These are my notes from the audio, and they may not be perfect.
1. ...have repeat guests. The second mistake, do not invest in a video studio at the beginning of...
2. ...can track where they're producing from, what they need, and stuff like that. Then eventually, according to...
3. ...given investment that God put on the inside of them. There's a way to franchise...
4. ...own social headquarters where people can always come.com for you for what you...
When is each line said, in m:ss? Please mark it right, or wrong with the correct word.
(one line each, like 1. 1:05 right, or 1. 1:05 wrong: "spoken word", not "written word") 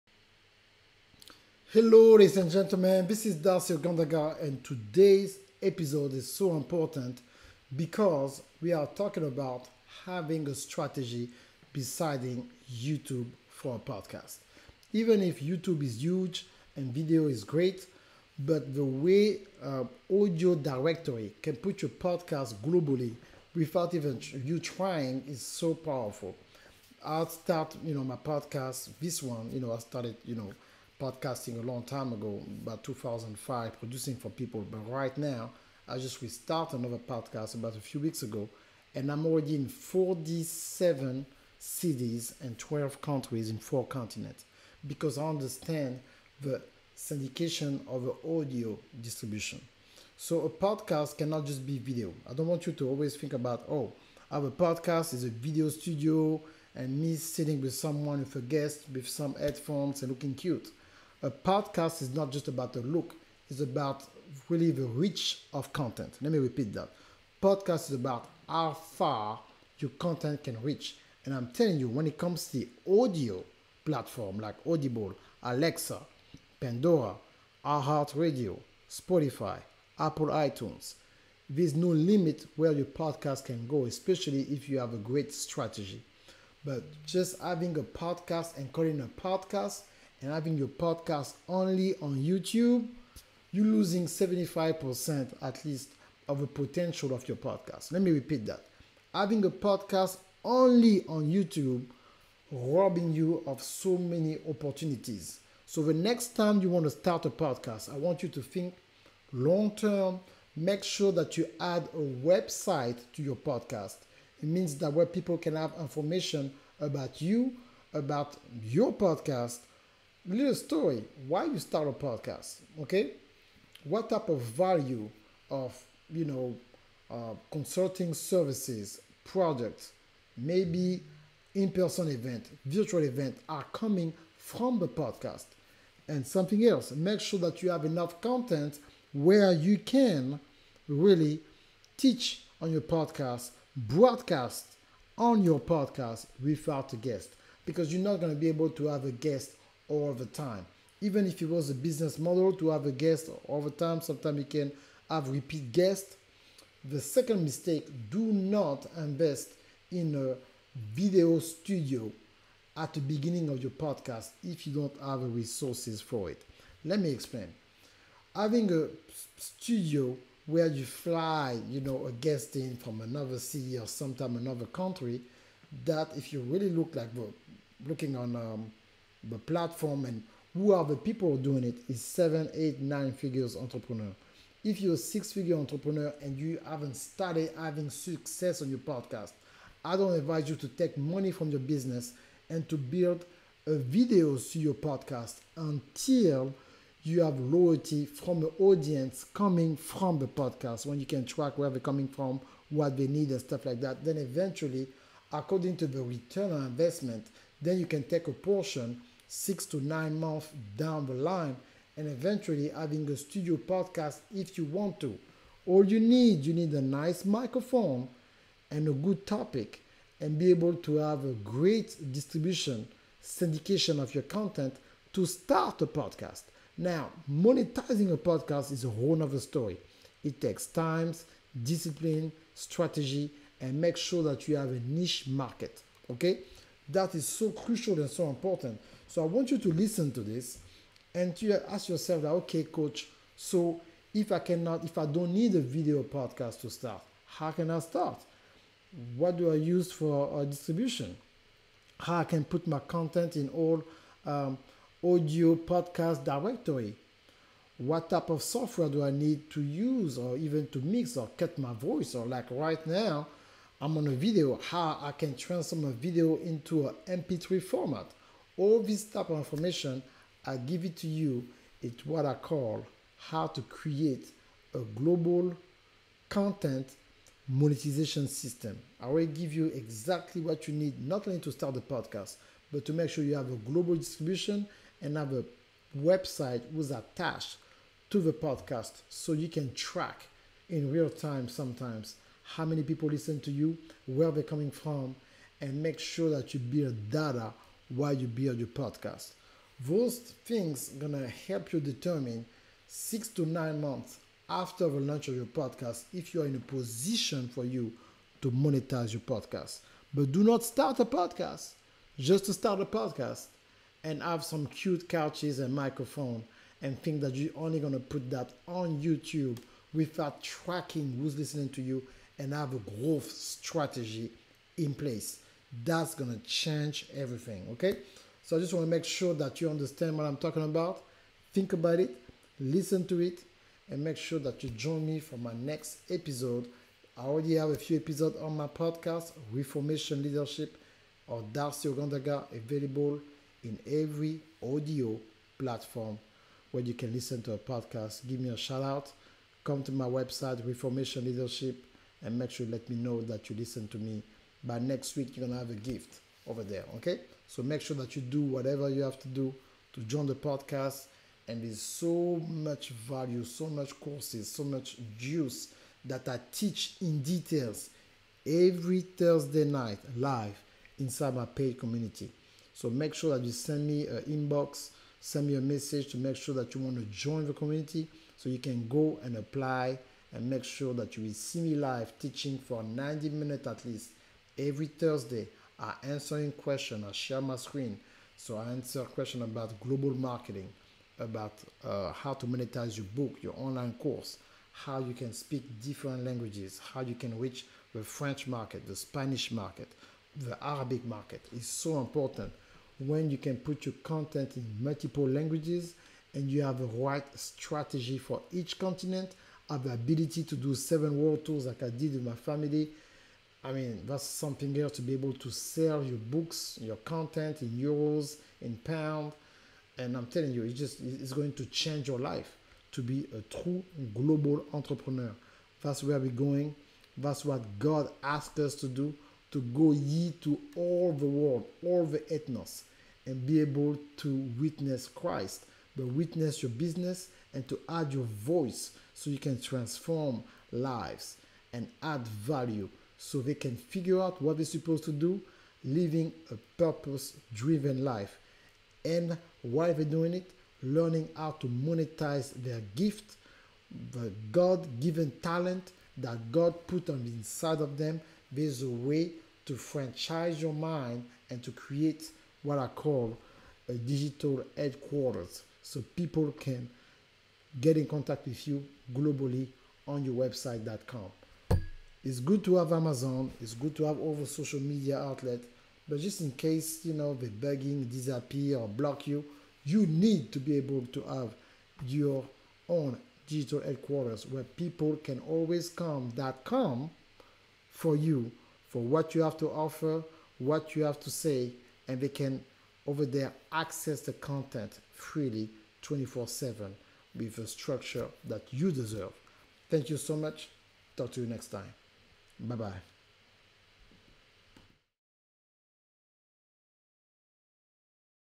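1. 2:35 right
2. 3:21 wrong: "coming", not "producing"
3. 7:34 wrong: "talent", not "investment"
4. 8:02 wrong: "digital", not "social".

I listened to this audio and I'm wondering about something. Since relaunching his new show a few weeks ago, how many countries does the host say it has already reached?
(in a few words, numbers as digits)
12.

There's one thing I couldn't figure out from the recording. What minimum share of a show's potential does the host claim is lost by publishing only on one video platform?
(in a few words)
75%.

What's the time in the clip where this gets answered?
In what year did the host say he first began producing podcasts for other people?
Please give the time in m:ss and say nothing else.
0:32.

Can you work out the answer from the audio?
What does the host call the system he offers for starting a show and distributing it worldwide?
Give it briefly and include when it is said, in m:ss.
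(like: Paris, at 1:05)
global content monetization system, at 4:34.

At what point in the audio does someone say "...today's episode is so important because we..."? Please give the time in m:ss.
0:04.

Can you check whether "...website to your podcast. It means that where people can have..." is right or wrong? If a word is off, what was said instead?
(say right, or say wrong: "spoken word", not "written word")
right.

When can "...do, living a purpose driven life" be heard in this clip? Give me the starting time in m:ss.
7:25.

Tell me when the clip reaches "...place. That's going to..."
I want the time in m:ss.
5:24.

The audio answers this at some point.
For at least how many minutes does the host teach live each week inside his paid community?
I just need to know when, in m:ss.
6:22.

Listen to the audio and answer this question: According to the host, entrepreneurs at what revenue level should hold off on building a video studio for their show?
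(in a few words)
six figure.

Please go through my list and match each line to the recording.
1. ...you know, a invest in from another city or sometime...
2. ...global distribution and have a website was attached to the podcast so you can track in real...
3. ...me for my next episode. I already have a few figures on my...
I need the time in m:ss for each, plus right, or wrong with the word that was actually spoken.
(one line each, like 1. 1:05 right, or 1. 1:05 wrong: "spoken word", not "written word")
1. 2:51 wrong: "guest", not "invest"
2. 4:43 right
3. 5:35 wrong: "episodes", not "figures".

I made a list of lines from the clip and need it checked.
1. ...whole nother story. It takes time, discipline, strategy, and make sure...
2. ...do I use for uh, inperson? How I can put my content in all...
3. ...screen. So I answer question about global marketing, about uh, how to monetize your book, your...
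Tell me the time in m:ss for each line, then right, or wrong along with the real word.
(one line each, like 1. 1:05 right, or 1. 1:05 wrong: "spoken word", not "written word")
1. 3:48 right
2. 4:09 wrong: "distribution", not "inperson"
3. 6:27 right.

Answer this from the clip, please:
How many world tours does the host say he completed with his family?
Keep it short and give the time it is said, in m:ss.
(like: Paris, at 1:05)
7, at 6:50.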